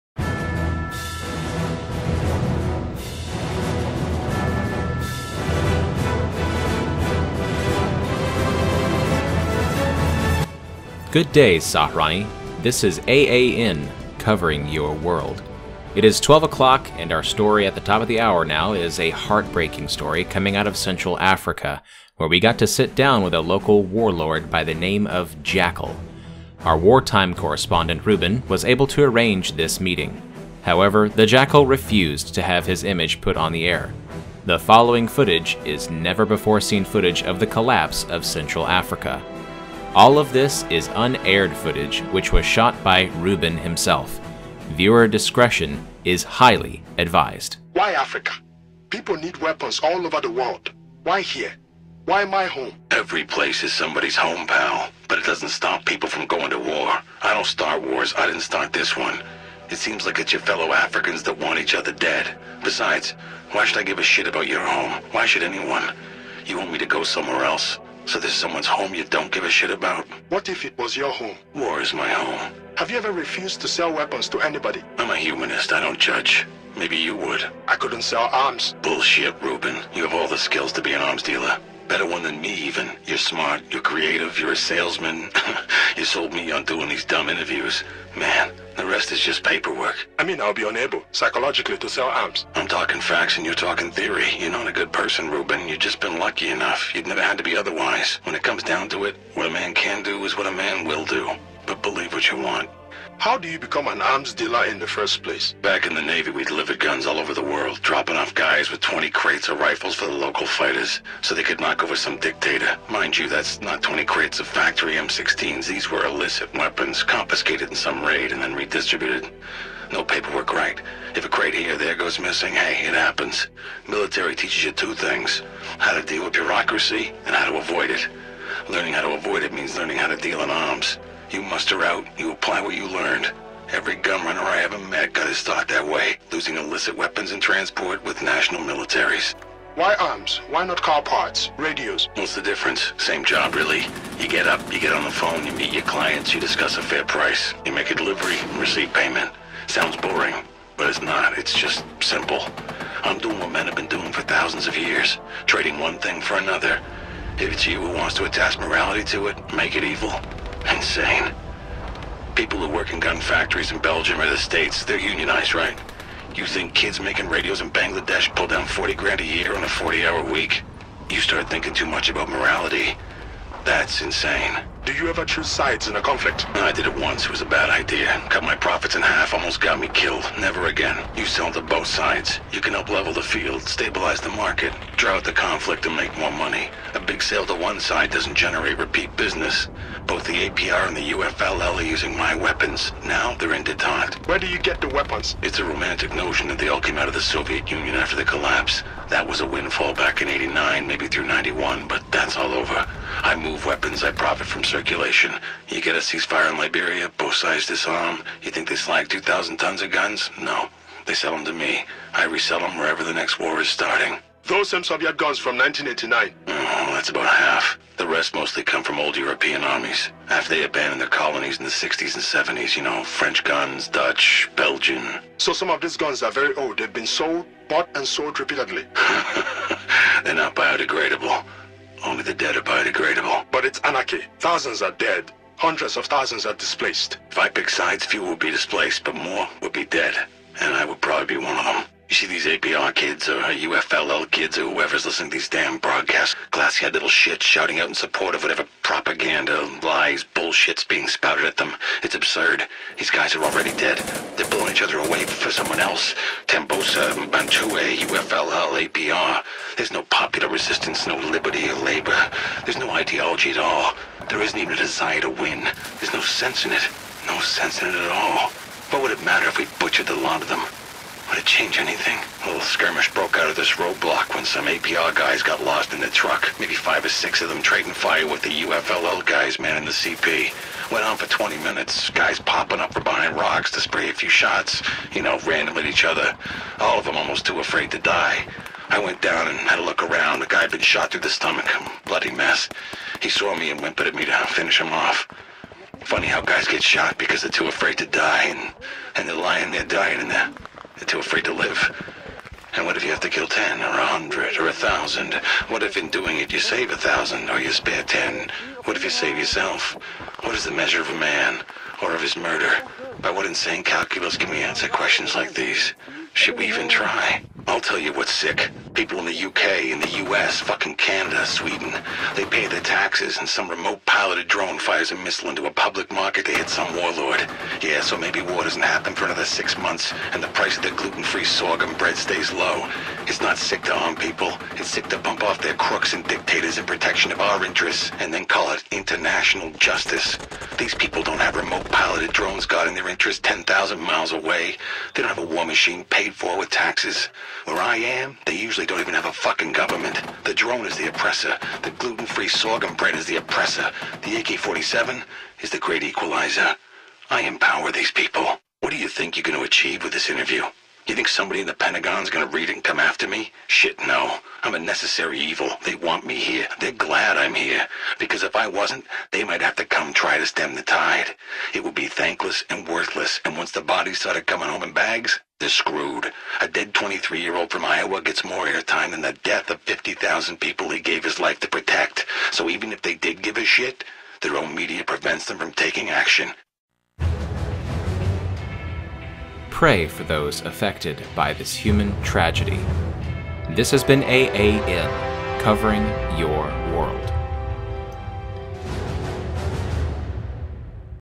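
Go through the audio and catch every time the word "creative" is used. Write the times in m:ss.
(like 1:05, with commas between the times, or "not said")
1:23.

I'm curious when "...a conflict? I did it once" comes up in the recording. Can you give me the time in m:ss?
2:55.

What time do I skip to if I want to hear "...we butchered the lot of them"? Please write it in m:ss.
4:29.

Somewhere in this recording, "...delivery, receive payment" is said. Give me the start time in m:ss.
2:27.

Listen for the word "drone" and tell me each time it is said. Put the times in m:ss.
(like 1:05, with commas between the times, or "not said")
5:24, 5:42, 5:50.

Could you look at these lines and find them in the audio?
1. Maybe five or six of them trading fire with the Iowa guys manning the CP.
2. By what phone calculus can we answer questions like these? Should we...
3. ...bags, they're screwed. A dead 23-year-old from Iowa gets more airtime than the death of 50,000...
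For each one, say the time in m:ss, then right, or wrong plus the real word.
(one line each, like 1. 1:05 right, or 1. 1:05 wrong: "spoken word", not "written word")
1. 4:36 wrong: "UFLL", not "Iowa"
2. 5:13 wrong: "insane", not "phone"
3. 6:14 right.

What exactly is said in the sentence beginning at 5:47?
Where I am, they usually actually don't even have a fucking government.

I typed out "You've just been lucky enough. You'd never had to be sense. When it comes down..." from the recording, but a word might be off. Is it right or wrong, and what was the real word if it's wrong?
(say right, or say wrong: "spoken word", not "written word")
wrong: "otherwise", not "sense".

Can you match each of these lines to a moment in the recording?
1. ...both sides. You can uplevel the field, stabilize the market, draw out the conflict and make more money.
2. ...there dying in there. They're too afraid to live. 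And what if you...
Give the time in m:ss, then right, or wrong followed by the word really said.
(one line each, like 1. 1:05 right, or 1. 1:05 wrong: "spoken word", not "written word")
1. 3:01 right
2. 4:59 right.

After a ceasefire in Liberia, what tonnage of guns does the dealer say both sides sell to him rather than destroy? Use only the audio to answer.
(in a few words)
2,000 tons.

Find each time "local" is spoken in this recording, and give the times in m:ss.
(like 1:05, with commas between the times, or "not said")
0:23, 1:50.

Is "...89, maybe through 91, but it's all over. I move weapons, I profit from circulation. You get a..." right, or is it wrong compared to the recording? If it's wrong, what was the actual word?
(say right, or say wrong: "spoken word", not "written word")
right.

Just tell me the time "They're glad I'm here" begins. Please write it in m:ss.
6:06.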